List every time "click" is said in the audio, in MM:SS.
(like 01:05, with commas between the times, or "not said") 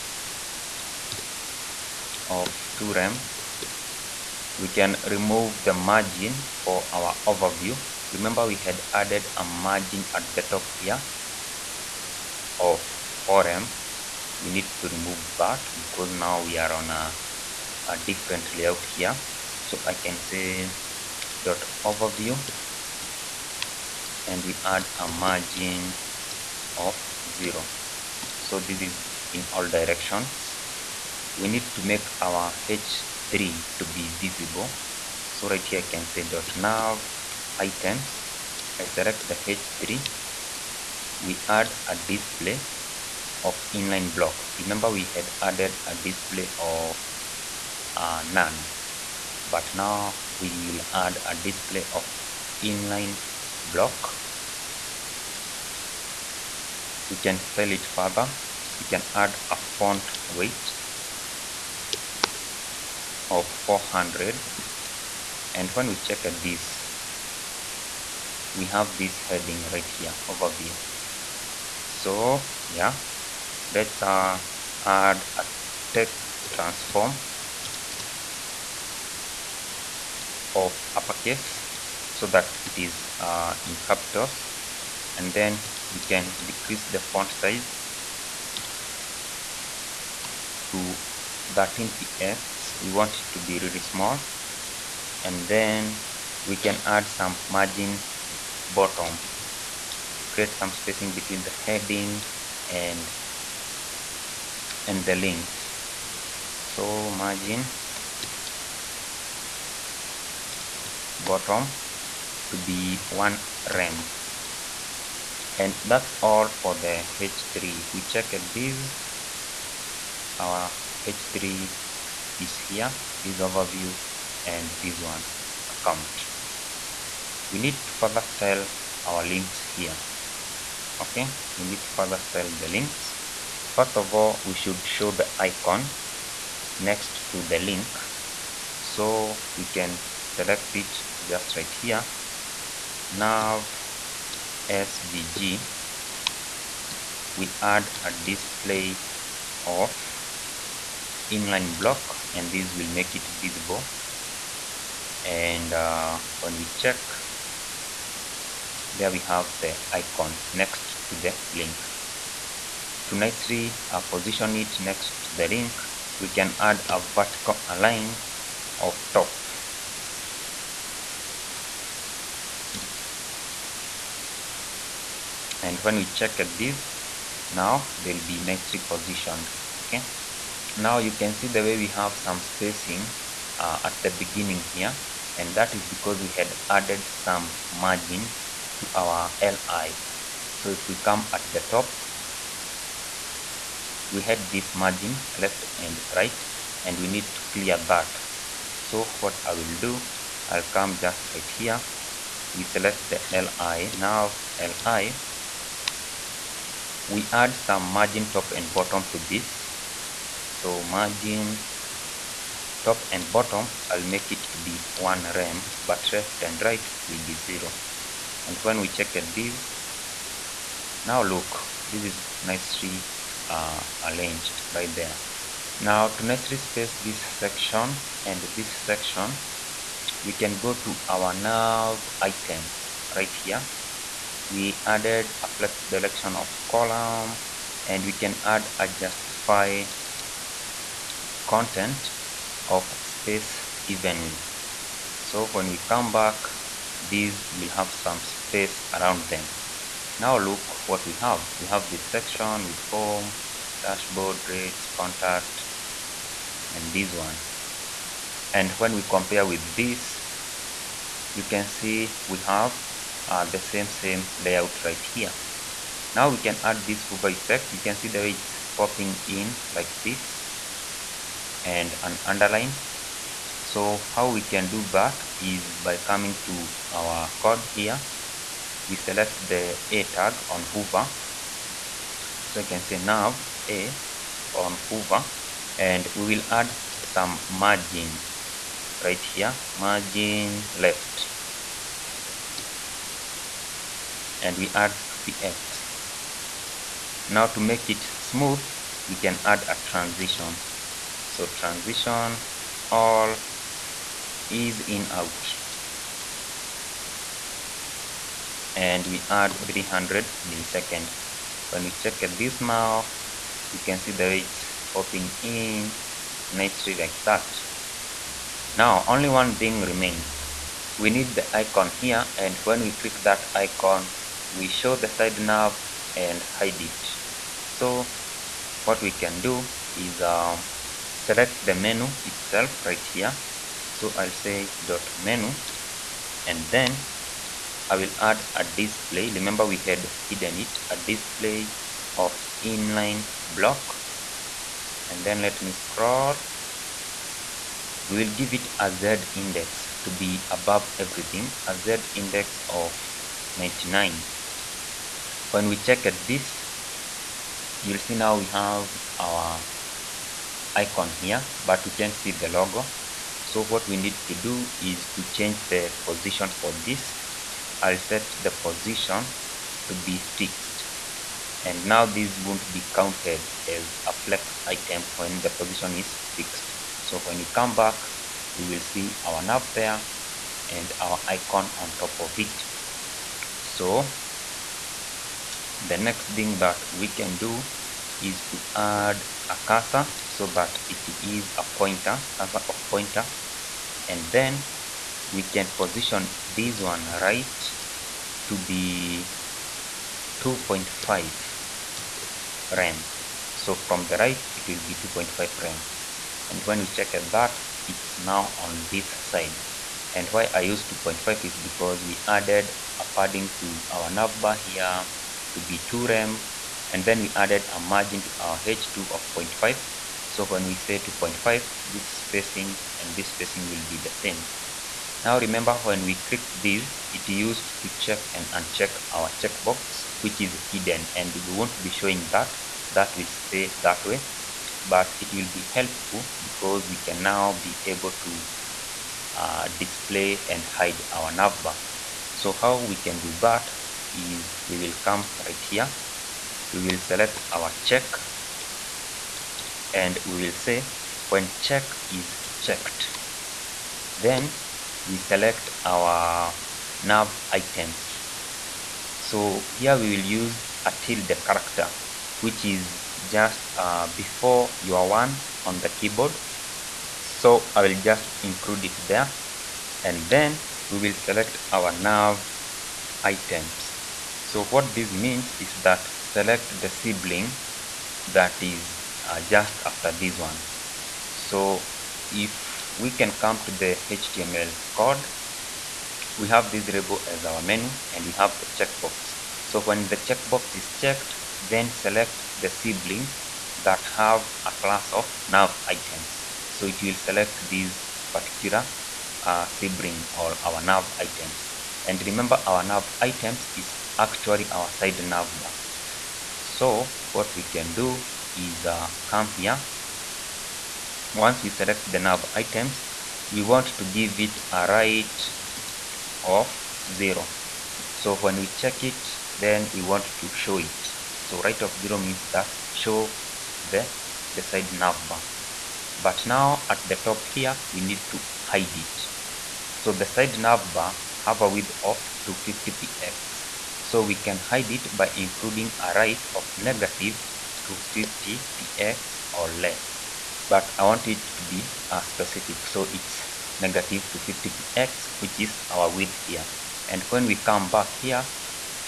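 05:22, 07:06.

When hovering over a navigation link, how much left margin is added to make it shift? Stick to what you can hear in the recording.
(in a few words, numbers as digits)
2px.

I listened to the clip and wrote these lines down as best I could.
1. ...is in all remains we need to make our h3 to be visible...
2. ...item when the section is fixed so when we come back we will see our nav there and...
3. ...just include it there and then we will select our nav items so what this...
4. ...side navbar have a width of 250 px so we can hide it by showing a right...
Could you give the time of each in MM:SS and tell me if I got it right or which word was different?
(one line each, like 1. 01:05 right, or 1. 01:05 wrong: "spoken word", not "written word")
1. 00:28 wrong: "directions", not "remains"
2. 06:14 wrong: "position", not "section"
3. 07:48 right
4. 08:50 wrong: "including", not "showing".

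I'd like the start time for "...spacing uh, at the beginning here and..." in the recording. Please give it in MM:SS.
03:02.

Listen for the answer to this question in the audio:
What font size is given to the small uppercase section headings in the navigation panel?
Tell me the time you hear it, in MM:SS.
01:31.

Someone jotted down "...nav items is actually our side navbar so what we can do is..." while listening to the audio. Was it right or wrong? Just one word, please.
right.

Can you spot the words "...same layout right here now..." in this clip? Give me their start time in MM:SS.
04:23.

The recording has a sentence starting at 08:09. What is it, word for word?
So when the checkbox is checked, then select the sibling that have a class of nav items.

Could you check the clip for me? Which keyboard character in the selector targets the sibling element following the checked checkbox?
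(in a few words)
tilde.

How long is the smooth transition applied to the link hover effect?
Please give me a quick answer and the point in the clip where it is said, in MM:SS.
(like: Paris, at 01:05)
300 milliseconds, at 05:09.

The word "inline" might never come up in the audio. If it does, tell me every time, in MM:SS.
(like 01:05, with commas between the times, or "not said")
00:43, 00:52, 02:31, 05:42.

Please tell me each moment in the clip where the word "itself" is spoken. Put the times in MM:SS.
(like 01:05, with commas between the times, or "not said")
05:32.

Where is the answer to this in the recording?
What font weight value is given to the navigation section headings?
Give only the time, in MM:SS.
01:03.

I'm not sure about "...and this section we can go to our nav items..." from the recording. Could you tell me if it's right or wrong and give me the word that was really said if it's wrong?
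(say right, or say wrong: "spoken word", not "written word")
right.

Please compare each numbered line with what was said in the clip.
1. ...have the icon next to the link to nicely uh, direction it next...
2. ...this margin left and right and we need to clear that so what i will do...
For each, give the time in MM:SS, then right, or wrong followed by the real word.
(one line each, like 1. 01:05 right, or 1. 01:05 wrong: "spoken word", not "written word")
1. 02:39 wrong: "position", not "direction"
2. 03:14 right.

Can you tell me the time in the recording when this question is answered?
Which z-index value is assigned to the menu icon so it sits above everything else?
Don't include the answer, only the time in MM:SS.
05:53.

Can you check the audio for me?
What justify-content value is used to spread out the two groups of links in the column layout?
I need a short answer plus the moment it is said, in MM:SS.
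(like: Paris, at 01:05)
space evenly, at 04:03.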